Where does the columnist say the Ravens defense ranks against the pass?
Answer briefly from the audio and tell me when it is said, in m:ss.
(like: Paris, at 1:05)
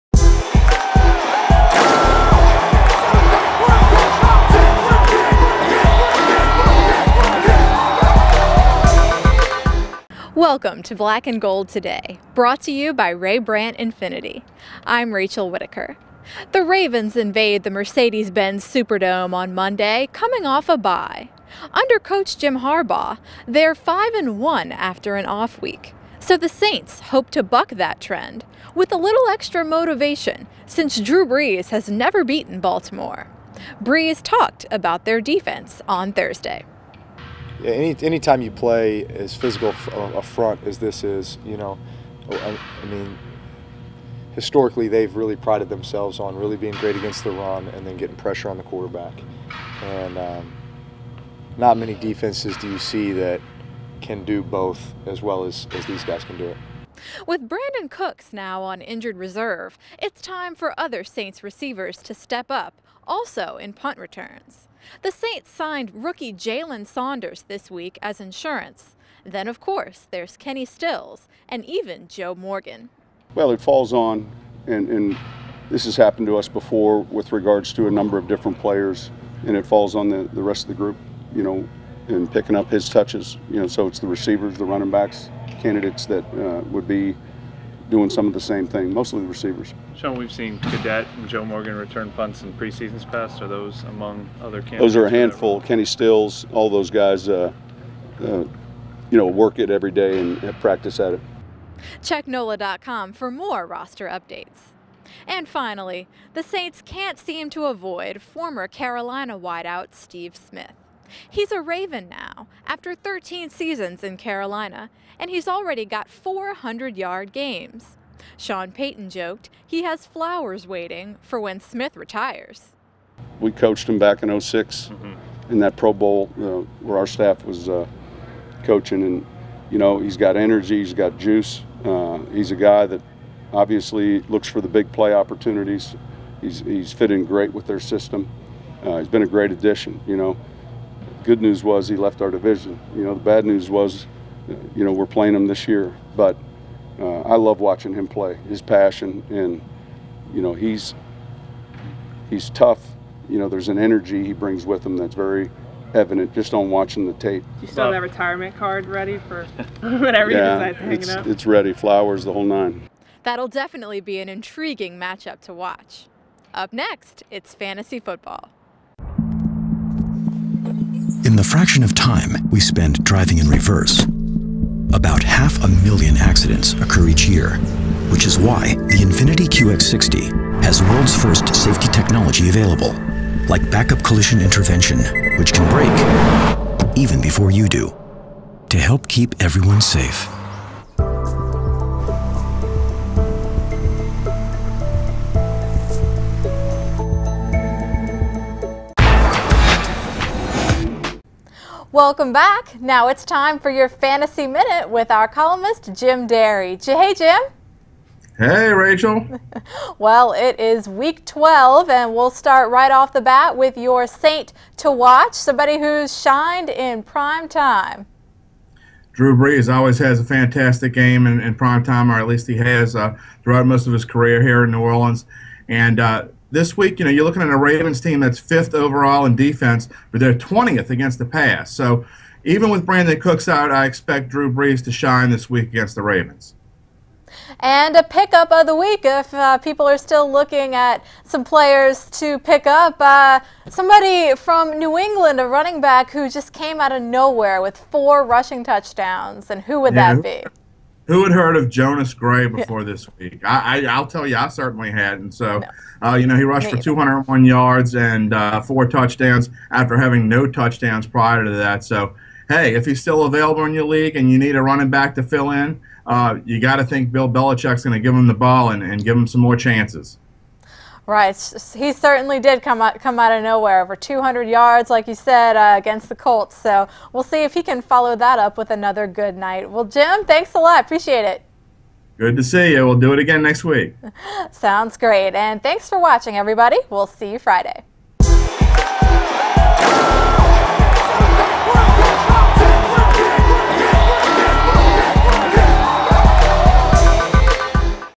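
20th, at 3:50.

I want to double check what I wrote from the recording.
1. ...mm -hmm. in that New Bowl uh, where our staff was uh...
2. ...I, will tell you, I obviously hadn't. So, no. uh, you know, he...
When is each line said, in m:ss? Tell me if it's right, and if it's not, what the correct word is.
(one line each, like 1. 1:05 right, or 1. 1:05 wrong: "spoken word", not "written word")
1. 2:04 wrong: "Pro", not "New"
2. 4:13 wrong: "certainly", not "obviously".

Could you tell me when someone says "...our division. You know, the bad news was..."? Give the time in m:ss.
2:22.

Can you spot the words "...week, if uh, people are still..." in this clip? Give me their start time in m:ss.
3:58.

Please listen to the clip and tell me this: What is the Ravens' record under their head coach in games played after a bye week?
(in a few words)
5 and 1.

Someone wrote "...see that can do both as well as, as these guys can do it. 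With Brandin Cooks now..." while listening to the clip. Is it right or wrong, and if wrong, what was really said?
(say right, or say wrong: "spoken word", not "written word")
right.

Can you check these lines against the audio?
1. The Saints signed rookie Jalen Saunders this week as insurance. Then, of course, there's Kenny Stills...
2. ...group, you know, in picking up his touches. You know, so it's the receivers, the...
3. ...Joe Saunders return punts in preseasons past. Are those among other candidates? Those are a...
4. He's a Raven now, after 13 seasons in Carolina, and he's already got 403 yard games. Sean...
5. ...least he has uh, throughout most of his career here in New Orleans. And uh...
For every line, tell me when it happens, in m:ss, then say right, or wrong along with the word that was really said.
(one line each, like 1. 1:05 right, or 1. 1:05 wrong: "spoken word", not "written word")
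1. 1:05 right
2. 1:20 right
3. 1:31 wrong: "Morgan", not "Saunders"
4. 1:51 wrong: "400", not "403"
5. 3:42 right.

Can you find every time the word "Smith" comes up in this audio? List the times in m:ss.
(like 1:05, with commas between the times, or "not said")
1:50, 2:01.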